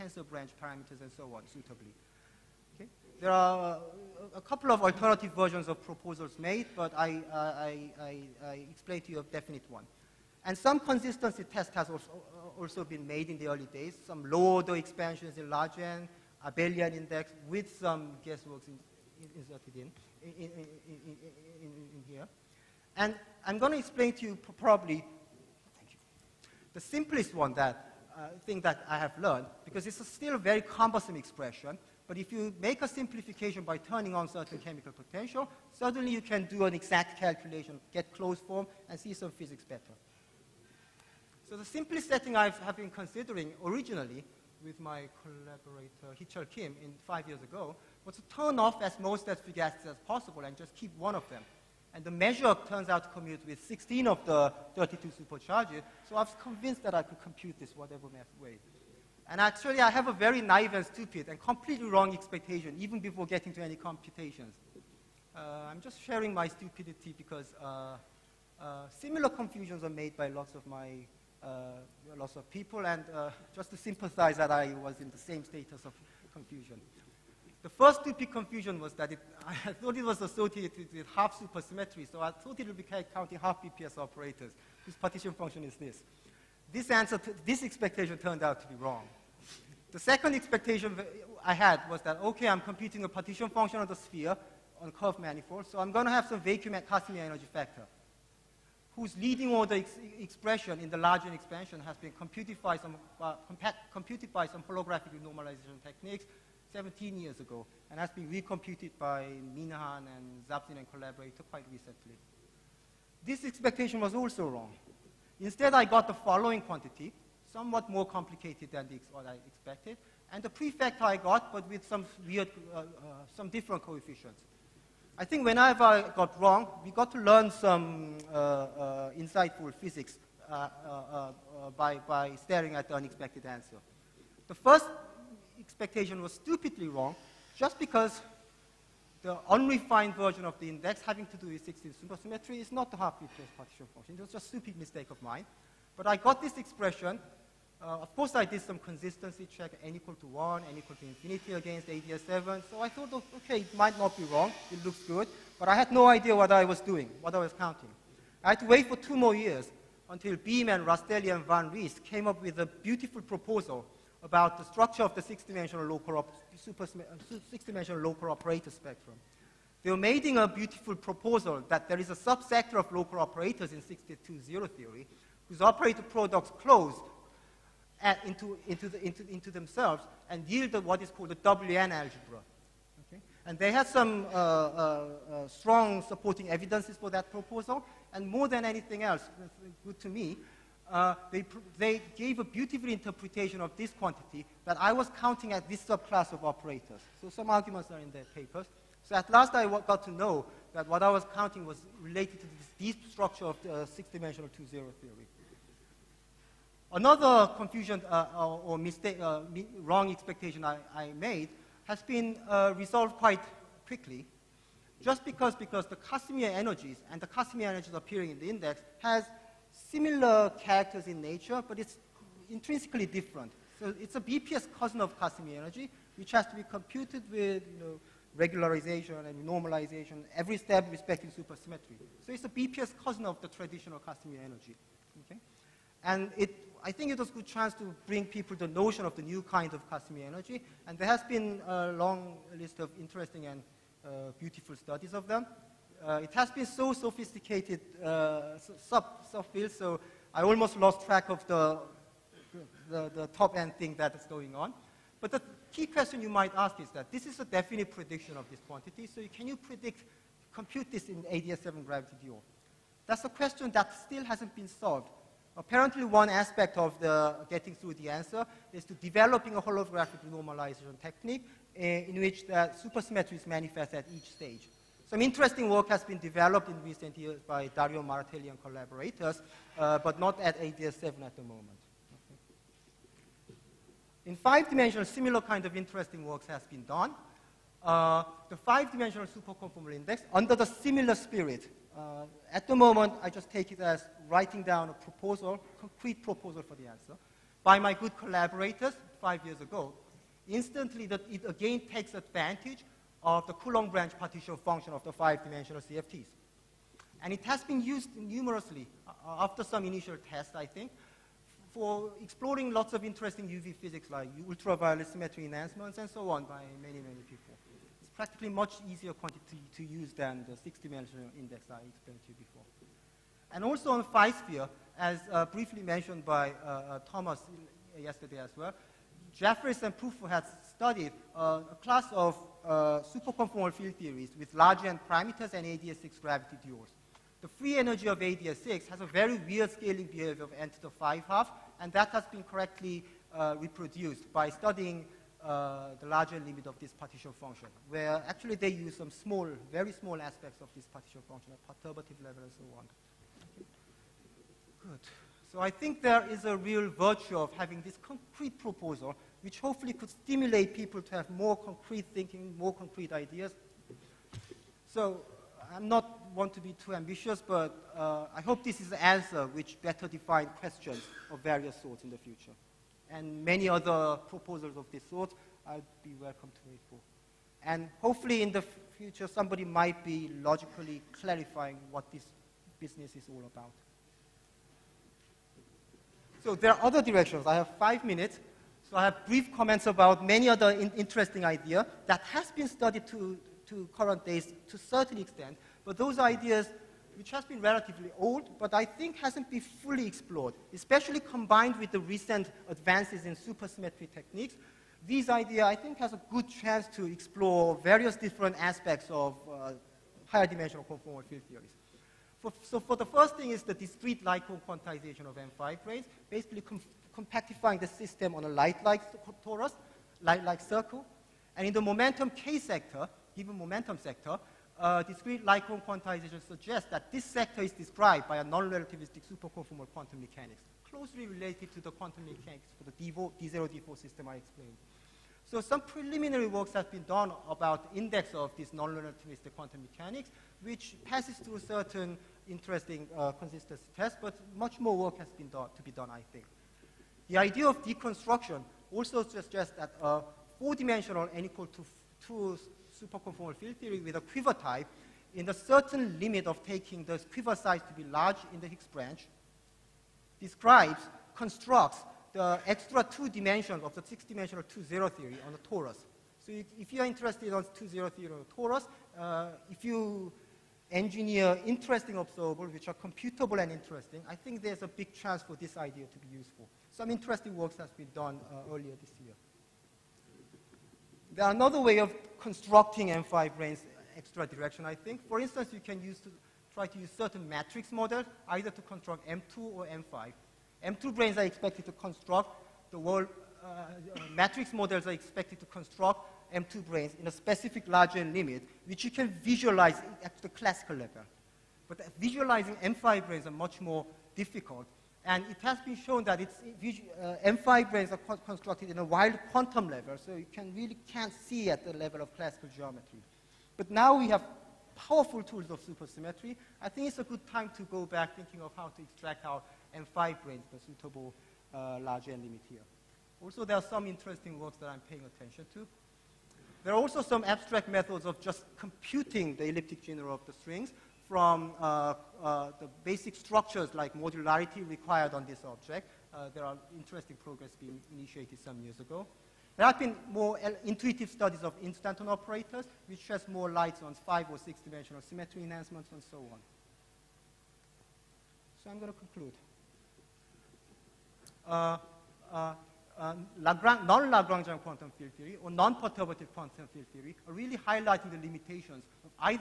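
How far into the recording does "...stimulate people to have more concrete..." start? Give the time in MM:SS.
06:00.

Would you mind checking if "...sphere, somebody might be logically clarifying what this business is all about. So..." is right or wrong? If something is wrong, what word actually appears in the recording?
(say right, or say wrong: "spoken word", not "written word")
wrong: "future", not "sphere".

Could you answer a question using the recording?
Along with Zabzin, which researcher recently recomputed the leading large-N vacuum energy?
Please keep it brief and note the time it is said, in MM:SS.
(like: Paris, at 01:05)
Minahan, at 01:49.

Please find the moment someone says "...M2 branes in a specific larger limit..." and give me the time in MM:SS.
08:16.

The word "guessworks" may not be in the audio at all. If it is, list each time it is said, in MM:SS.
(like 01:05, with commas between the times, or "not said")
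00:18.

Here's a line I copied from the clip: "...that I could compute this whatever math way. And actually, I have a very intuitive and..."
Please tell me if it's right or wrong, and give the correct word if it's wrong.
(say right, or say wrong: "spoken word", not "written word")
wrong: "naive", not "intuitive".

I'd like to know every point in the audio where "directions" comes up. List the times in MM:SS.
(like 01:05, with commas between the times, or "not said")
06:27, 08:04.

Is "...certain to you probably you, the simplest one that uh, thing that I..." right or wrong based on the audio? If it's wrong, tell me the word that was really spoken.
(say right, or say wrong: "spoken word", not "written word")
wrong: "explain", not "certain".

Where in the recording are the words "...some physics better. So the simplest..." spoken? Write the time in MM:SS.
00:39.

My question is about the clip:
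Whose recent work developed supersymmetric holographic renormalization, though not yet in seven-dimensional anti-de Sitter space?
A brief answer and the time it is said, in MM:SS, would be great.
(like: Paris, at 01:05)
Dario Martelli, at 04:37.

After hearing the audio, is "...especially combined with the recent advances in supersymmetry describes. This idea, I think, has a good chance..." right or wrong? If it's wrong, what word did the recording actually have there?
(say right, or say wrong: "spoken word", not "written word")
wrong: "techniques", not "describes".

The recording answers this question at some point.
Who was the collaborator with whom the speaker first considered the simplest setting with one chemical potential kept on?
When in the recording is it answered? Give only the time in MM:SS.
00:46.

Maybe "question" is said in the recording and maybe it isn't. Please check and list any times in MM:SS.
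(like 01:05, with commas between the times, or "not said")
04:15, 04:23, 06:10.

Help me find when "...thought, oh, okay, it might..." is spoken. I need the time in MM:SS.
02:32.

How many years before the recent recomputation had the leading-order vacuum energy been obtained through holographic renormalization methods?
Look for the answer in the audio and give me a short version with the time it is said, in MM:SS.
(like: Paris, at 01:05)
17, at 01:46.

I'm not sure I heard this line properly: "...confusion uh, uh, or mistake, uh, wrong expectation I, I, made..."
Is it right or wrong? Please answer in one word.
right.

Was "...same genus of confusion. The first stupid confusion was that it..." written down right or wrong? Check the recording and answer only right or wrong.
wrong.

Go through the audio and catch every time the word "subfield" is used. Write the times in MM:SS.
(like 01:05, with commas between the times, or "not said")
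04:09.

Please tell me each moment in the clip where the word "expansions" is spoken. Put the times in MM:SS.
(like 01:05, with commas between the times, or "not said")
00:14, 01:41.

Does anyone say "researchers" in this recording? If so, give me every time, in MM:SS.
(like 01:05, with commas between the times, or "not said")
not said.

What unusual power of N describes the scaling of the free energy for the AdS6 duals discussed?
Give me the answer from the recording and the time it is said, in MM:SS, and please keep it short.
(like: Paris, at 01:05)
N to the 5/2, at 05:40.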